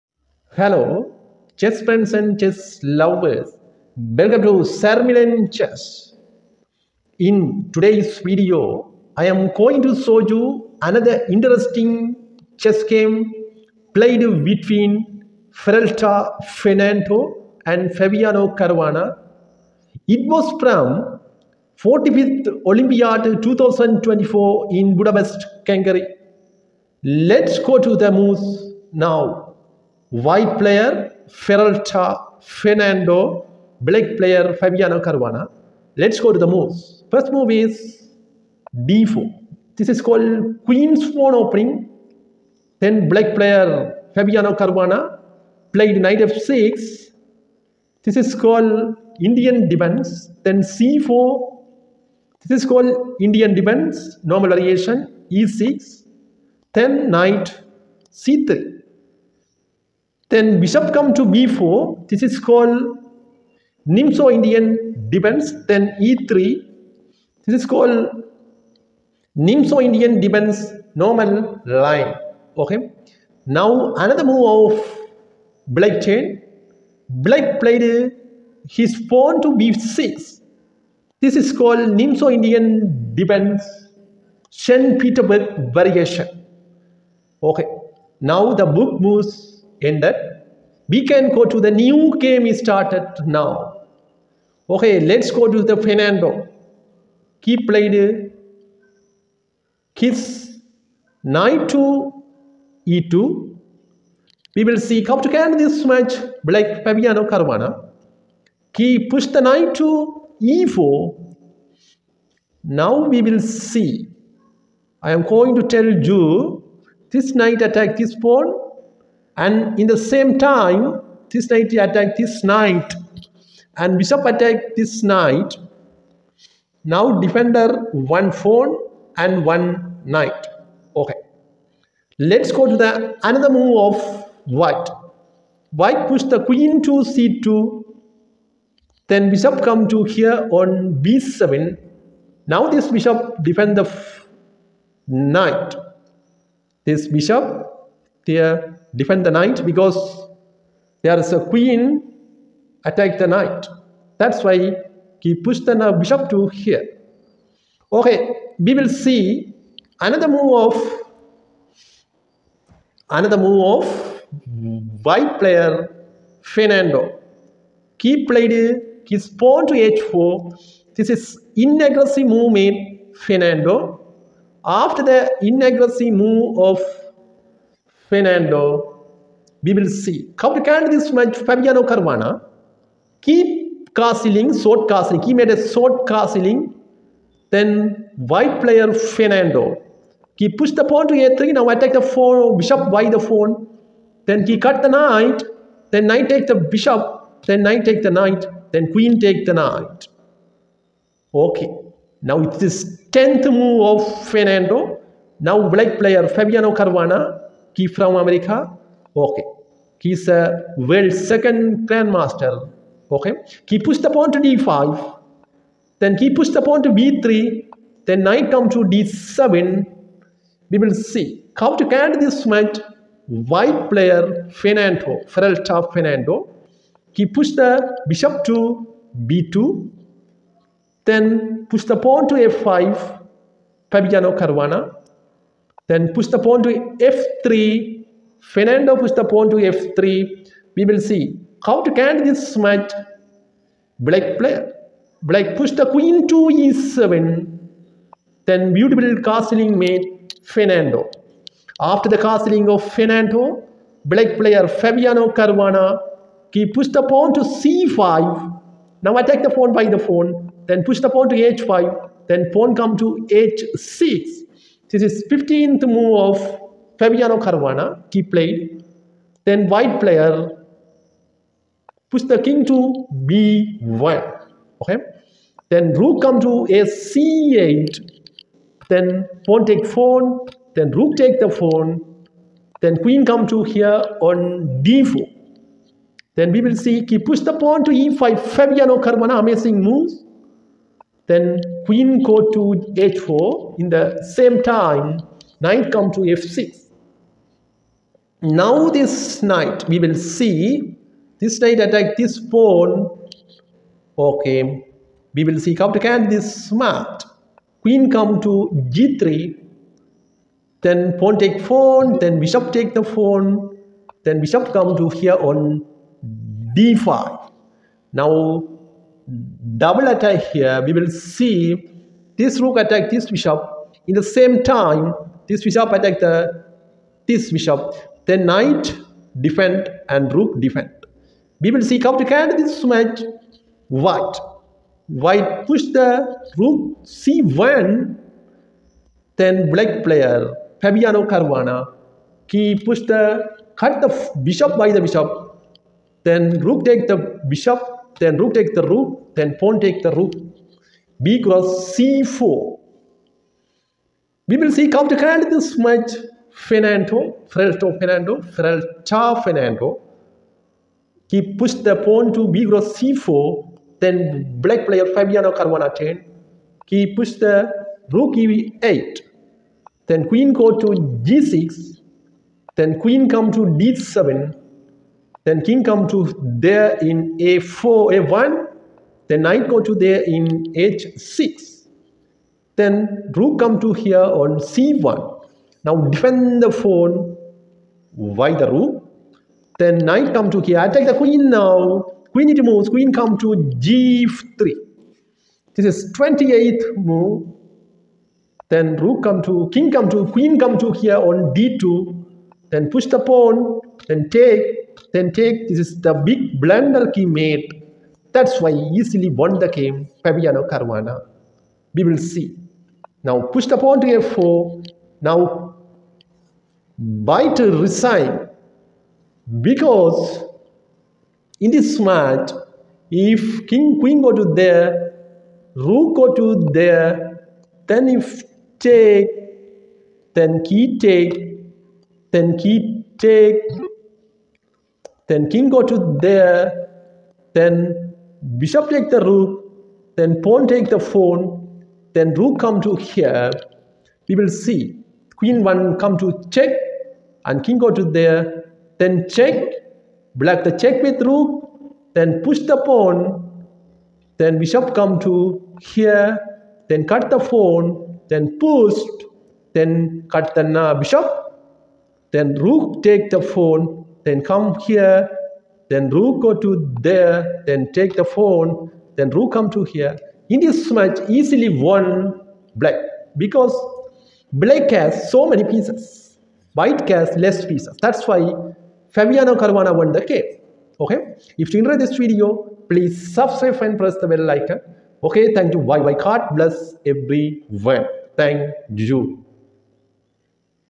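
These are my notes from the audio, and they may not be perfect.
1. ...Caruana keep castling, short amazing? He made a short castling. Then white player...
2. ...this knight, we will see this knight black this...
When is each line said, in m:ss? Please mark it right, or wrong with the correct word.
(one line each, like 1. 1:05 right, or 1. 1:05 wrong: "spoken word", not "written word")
1. 3:01 wrong: "castling", not "amazing"
2. 4:58 wrong: "attack", not "black".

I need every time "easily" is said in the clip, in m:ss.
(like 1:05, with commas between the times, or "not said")
6:48, 7:51.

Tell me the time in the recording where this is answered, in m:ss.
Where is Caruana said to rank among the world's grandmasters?
3:30.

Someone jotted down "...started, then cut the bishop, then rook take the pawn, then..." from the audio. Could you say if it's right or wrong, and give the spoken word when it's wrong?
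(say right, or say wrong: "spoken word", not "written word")
wrong: "pushed", not "started".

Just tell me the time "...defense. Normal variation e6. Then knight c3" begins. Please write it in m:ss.
0:53.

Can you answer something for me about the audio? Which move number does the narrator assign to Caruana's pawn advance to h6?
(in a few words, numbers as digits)
15.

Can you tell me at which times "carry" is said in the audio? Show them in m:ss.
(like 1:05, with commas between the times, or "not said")
3:41, 5:32.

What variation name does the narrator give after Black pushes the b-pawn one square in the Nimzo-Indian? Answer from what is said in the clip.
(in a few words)
St. Peterberg variation.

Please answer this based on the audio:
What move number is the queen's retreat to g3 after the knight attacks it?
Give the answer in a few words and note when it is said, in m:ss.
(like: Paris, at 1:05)
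28, at 6:36.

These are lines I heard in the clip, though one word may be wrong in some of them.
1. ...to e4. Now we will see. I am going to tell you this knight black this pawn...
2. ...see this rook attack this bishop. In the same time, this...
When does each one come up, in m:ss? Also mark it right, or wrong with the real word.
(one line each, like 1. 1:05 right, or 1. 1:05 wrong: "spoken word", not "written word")
1. 1:49 wrong: "attack", not "black"
2. 5:21 right.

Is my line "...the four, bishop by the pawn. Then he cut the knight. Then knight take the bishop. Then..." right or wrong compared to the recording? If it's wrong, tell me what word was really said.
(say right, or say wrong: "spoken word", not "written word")
right.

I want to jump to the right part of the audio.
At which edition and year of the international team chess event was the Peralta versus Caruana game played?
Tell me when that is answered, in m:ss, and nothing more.
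0:21.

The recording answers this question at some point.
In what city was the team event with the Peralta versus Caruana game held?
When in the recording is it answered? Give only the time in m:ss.
0:24.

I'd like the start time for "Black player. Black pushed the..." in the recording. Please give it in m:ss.
4:03.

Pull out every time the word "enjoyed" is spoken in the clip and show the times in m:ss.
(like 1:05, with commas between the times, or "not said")
8:01.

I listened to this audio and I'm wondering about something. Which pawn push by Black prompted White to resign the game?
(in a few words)
f4.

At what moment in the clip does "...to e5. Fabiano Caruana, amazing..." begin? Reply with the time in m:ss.
4:47.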